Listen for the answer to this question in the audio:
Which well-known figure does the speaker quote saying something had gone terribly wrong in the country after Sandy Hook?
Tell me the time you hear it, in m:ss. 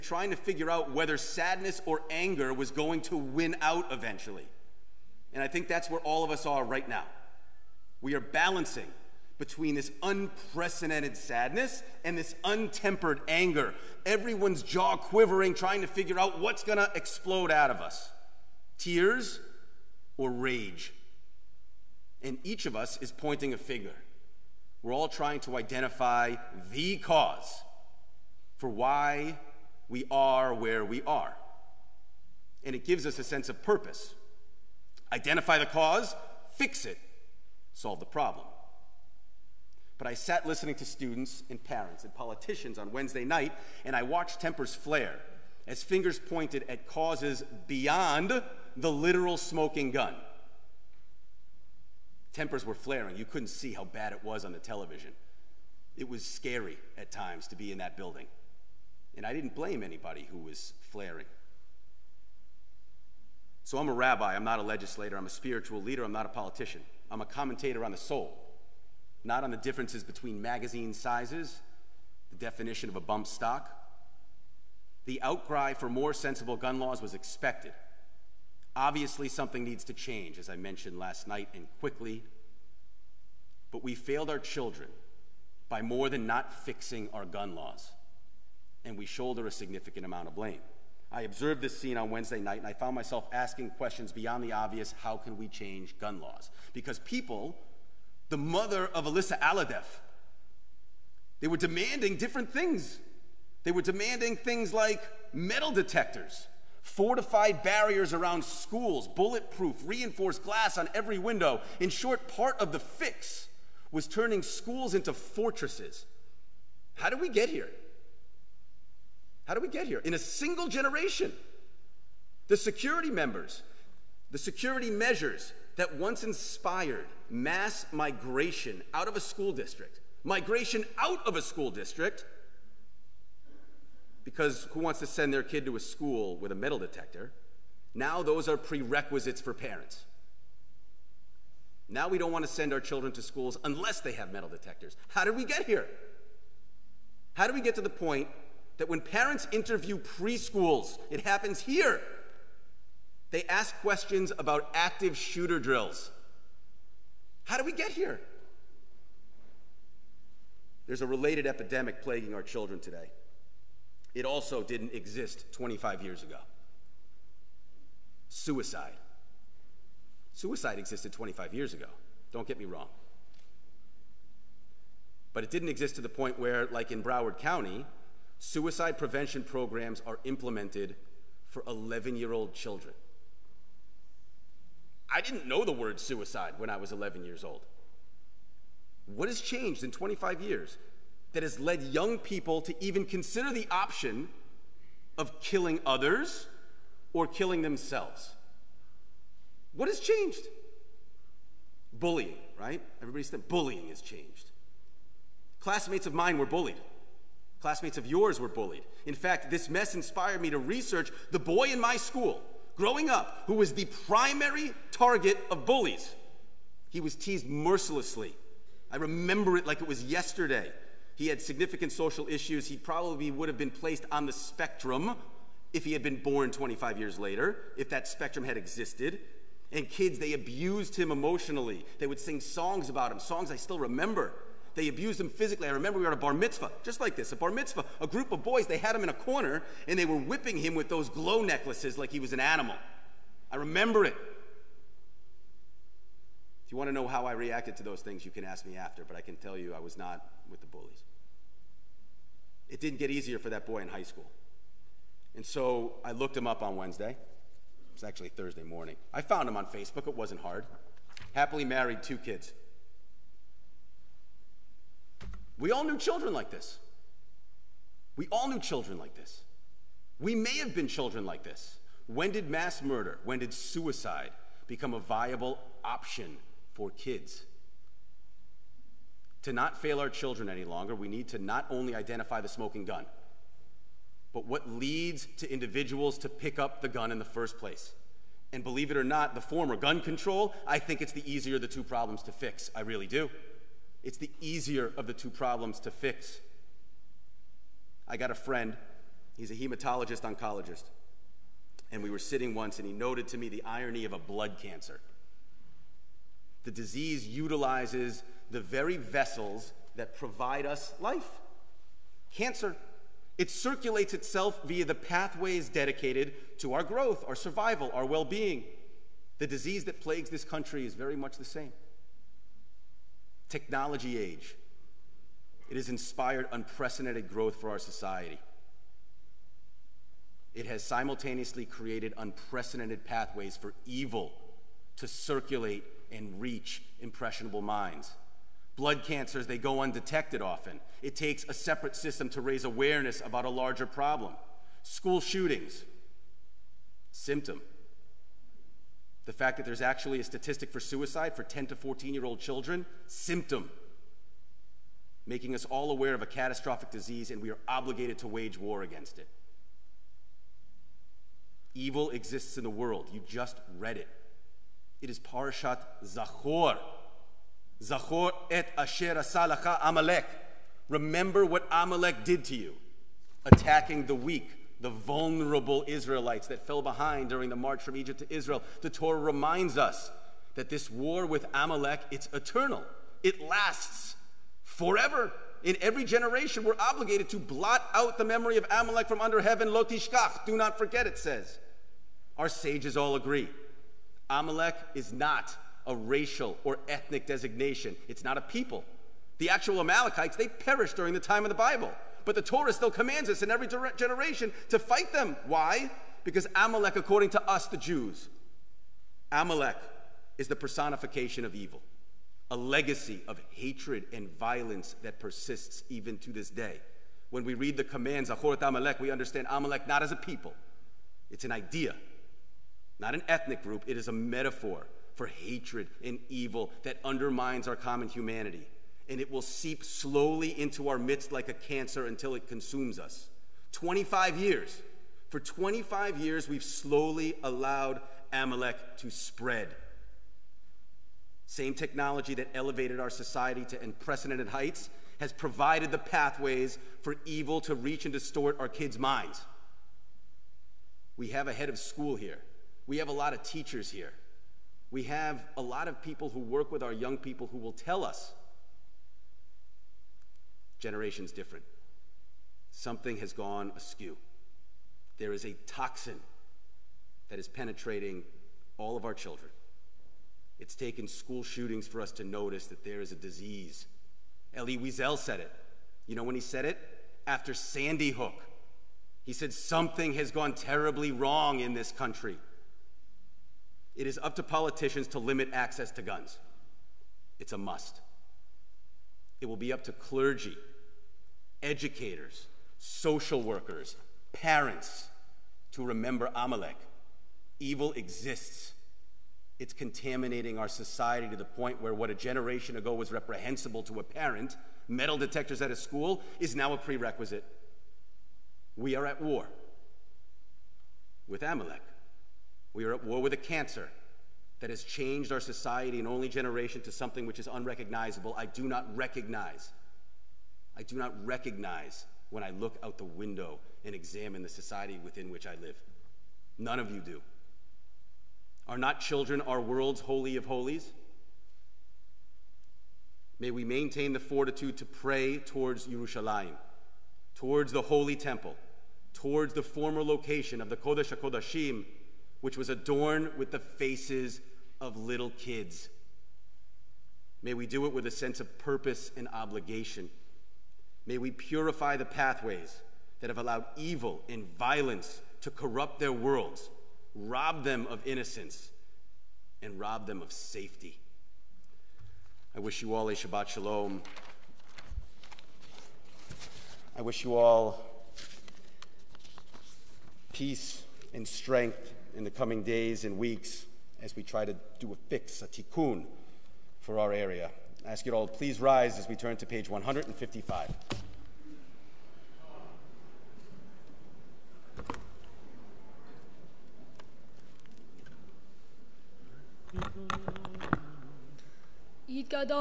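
7:54.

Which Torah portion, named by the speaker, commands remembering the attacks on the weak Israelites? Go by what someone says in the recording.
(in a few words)
Parashat Zachor.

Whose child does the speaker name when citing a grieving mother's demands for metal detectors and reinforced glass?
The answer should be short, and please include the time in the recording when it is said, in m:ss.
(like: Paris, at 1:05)
Alyssa Alhadeff, at 1:39.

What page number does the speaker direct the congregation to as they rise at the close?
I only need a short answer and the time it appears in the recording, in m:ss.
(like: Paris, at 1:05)
155, at 9:39.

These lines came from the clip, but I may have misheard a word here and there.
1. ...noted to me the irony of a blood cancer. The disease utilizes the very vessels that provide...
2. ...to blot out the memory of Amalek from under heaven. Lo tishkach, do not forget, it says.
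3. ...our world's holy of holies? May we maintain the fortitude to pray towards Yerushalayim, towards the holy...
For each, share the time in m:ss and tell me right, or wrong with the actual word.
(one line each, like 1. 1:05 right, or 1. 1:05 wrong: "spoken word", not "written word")
1. 5:02 right
2. 6:27 right
3. 8:49 right.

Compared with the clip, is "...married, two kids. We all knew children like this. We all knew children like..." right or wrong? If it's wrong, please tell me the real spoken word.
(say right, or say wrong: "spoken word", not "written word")
right.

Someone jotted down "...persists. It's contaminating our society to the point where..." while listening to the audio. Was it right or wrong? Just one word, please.
wrong.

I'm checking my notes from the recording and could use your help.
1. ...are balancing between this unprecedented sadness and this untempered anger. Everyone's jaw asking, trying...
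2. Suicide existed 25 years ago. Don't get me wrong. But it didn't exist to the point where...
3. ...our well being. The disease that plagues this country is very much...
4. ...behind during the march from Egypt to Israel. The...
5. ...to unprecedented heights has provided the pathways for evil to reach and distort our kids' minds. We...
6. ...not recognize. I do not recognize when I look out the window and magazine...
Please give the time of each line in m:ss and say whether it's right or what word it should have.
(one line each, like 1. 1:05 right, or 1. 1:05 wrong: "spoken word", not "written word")
1. 0:08 wrong: "quivering", not "asking"
2. 2:50 right
3. 5:17 right
4. 6:16 right
5. 7:23 right
6. 8:38 wrong: "examine", not "magazine".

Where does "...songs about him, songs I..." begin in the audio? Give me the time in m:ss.
3:52.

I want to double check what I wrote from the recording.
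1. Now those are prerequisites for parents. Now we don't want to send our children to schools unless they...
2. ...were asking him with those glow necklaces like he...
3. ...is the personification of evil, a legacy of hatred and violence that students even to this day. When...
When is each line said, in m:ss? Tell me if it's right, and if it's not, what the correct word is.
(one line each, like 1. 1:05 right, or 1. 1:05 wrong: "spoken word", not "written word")
1. 2:17 right
2. 4:00 wrong: "whipping", not "asking"
3. 6:50 wrong: "persists", not "students".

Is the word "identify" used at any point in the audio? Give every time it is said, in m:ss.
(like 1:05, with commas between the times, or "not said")
0:25, 0:35, 4:41.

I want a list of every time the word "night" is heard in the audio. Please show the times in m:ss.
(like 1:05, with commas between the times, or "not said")
0:43, 1:21, 1:32.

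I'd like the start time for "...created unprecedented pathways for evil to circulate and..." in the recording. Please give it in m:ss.
5:31.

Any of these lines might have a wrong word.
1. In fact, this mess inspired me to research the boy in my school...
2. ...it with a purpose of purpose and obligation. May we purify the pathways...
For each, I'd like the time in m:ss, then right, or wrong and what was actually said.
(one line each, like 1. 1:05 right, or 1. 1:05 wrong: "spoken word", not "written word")
1. 3:29 right
2. 9:07 wrong: "sense", not "purpose".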